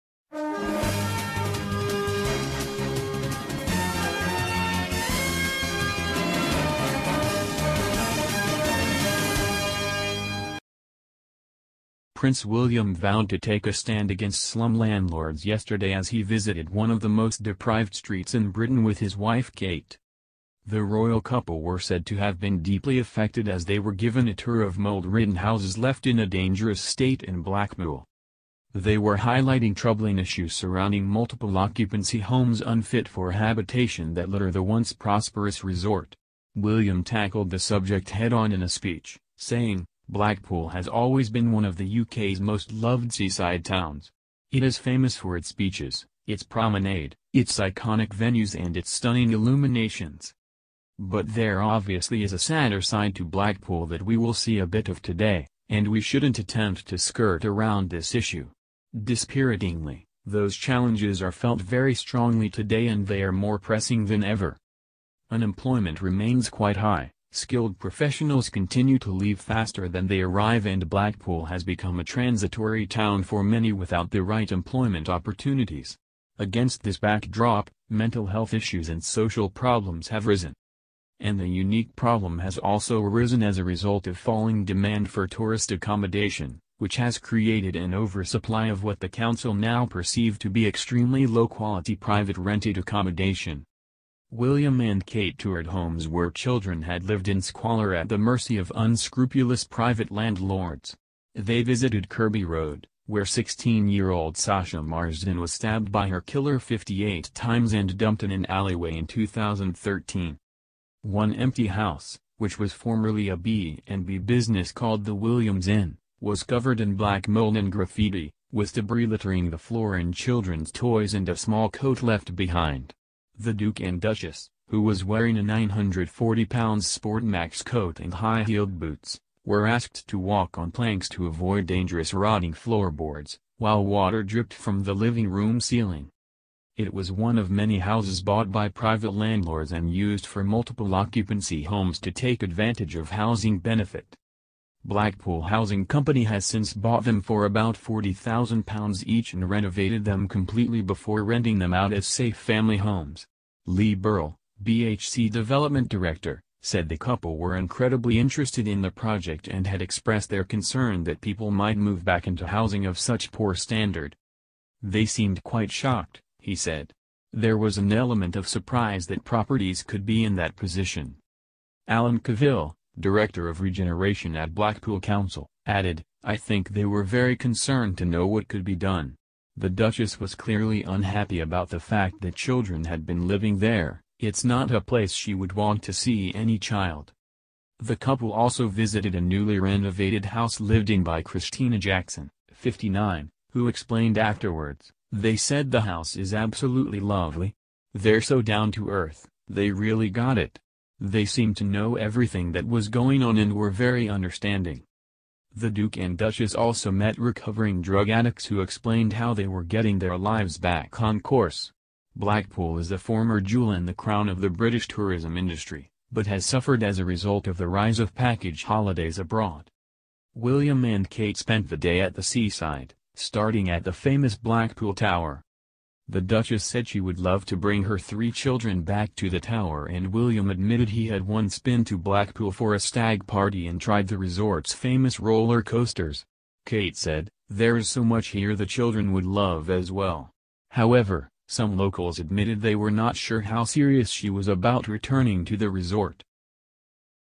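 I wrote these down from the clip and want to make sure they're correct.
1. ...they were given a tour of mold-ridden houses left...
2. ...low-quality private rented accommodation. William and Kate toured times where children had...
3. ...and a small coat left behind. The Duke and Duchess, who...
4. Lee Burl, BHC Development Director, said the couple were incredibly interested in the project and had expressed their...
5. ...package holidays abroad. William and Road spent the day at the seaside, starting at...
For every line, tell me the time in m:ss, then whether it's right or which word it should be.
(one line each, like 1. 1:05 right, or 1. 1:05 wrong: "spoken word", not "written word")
1. 0:23 right
2. 1:31 wrong: "homes", not "times"
3. 2:01 right
4. 2:33 right
5. 3:38 wrong: "Kate", not "Road".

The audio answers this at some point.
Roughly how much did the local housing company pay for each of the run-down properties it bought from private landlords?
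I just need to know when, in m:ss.
2:27.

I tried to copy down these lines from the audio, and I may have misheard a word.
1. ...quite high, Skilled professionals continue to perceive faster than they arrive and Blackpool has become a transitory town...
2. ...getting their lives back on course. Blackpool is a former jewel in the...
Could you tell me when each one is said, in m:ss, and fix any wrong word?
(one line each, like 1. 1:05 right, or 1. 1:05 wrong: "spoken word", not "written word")
1. 1:06 wrong: "leave", not "perceive"
2. 3:29 right.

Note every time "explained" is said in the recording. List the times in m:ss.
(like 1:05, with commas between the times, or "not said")
3:13, 3:28.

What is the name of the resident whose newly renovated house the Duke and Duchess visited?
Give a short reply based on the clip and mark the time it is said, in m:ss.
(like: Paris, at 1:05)
Christina Jackson, at 3:11.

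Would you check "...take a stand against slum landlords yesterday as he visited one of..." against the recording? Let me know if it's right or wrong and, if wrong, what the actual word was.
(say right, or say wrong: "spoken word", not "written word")
right.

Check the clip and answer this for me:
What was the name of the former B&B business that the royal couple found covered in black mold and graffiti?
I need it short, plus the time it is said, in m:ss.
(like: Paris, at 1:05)
Williams Inn, at 1:55.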